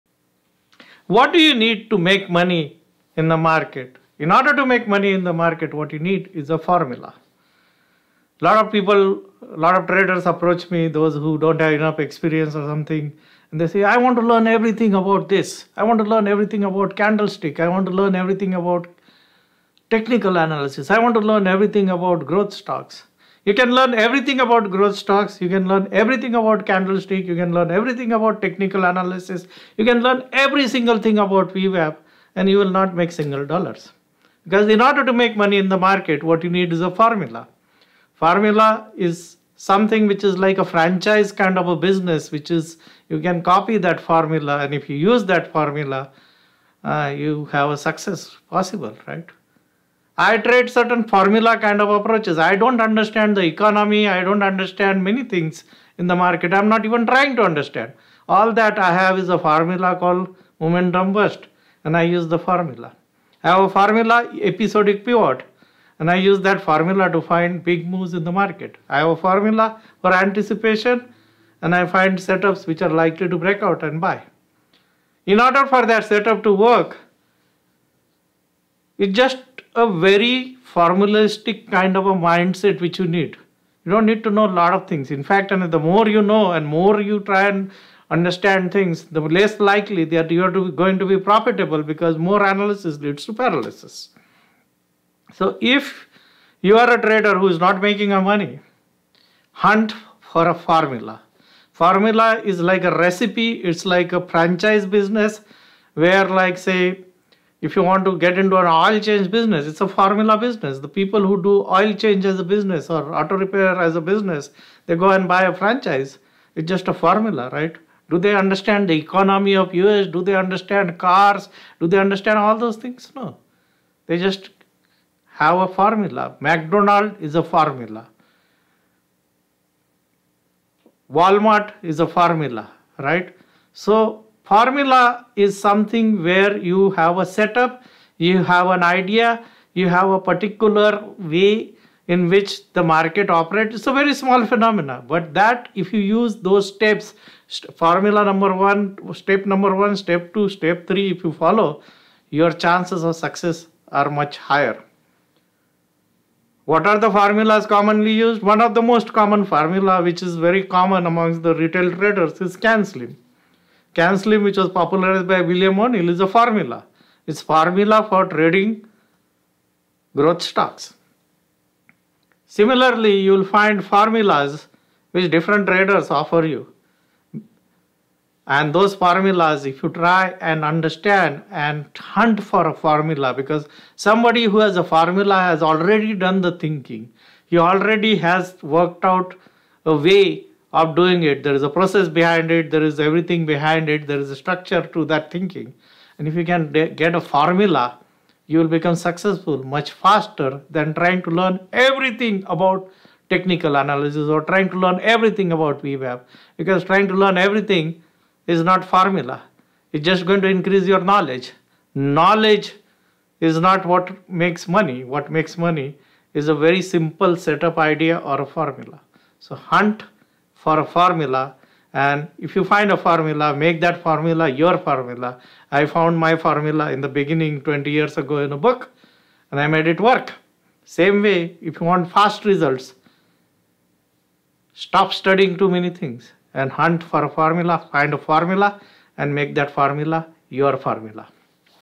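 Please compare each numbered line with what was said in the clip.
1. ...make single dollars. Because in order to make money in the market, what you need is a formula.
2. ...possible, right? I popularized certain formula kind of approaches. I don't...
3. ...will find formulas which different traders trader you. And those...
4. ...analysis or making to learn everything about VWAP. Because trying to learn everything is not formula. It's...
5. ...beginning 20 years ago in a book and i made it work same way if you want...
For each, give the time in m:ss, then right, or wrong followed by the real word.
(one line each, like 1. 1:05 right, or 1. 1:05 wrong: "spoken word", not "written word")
1. 0:32 right
2. 0:48 wrong: "tried", not "popularized"
3. 2:53 wrong: "offer", not "trader"
4. 3:23 wrong: "trying", not "making"
5. 3:47 right.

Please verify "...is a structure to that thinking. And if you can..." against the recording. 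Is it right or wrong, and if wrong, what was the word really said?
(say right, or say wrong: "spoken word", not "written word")
right.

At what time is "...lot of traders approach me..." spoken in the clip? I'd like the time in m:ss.
0:09.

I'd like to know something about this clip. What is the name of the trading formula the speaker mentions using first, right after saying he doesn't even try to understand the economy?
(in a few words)
momentum burst.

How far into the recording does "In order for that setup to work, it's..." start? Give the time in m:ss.
1:15.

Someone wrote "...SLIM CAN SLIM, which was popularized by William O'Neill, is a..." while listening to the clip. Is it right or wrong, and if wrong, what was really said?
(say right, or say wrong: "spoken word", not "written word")
right.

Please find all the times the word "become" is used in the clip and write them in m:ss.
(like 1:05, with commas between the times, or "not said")
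3:18.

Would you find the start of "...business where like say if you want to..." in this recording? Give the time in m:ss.
1:44.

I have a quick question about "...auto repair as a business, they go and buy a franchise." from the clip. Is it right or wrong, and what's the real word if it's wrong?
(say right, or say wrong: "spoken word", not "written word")
right.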